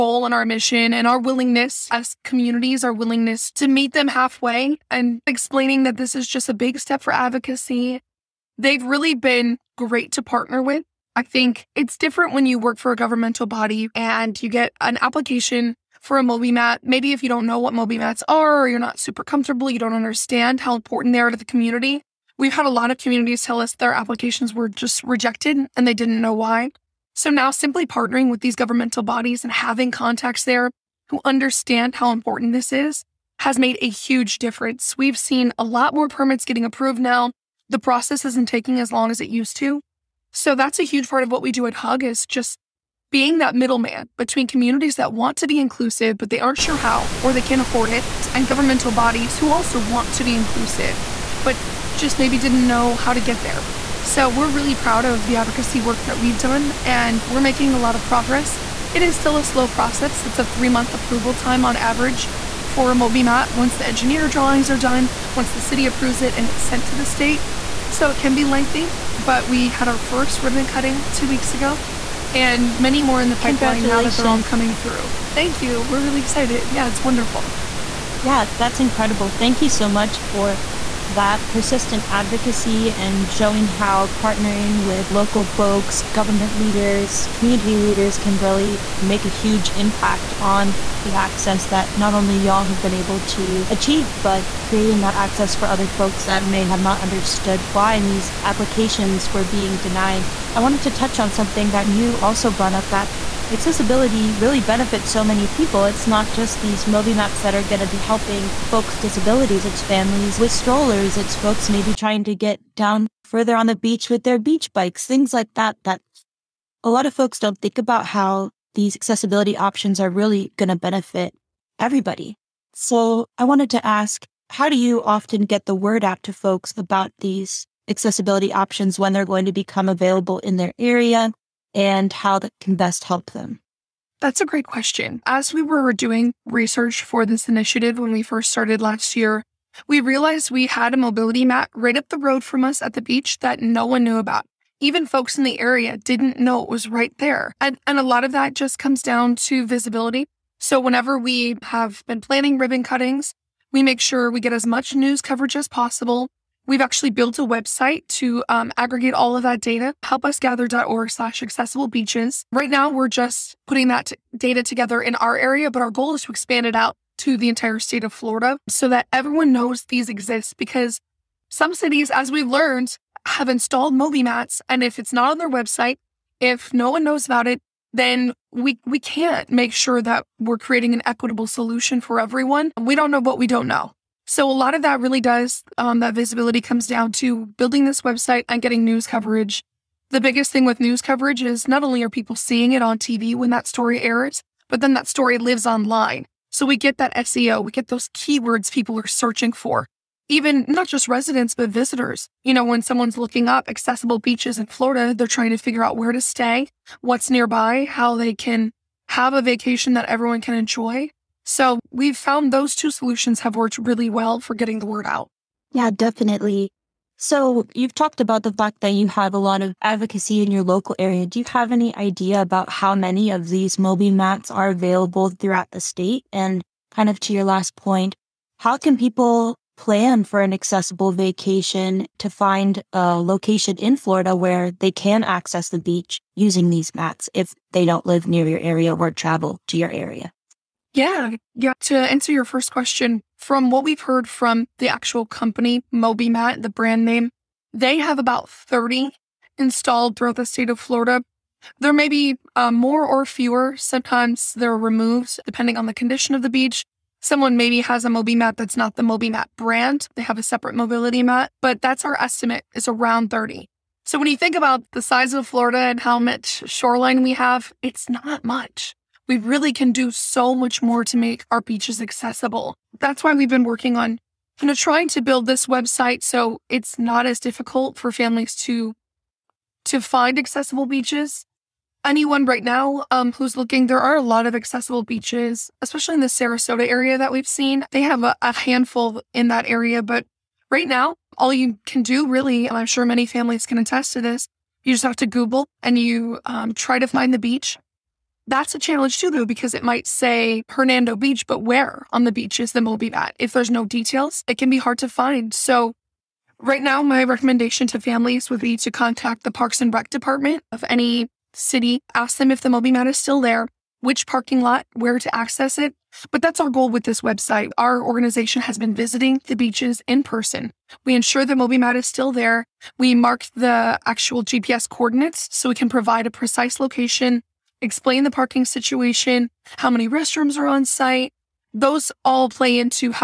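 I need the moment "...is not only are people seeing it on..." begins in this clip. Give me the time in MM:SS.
03:11.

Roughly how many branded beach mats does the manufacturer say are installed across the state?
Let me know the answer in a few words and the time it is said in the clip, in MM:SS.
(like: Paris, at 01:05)
30, at 04:08.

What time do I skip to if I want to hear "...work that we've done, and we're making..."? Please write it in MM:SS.
00:55.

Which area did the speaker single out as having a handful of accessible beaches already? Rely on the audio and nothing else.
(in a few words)
Sarasota.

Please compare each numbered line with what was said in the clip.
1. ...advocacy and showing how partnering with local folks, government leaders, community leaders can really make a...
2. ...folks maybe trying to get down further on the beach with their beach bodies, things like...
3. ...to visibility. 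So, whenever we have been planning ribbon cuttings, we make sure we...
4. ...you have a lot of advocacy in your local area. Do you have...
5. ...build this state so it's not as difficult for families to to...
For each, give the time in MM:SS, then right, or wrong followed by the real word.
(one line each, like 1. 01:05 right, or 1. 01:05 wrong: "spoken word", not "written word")
1. 01:22 right
2. 01:51 wrong: "bikes", not "bodies"
3. 02:29 right
4. 03:38 right
5. 04:35 wrong: "website", not "state".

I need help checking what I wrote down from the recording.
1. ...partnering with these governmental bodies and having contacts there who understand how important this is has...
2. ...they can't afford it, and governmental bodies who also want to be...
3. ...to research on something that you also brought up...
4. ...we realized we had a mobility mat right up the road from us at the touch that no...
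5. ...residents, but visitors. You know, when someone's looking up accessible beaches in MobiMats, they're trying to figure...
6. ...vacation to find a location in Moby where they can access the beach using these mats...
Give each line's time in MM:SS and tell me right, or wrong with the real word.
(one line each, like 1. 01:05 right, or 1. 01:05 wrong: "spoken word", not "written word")
1. 00:27 right
2. 00:47 right
3. 01:40 wrong: "touch", not "research"
4. 02:19 wrong: "beach", not "touch"
5. 03:21 wrong: "Florida", not "MobiMats"
6. 03:51 wrong: "Florida", not "Moby".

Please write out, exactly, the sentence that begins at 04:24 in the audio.
So when you think about the size of Florida and how much shoreline we have, it's not much.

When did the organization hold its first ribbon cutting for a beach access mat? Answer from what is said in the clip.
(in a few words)
2 weeks ago.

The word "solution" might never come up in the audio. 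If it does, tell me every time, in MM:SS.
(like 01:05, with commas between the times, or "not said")
03:01, 03:32.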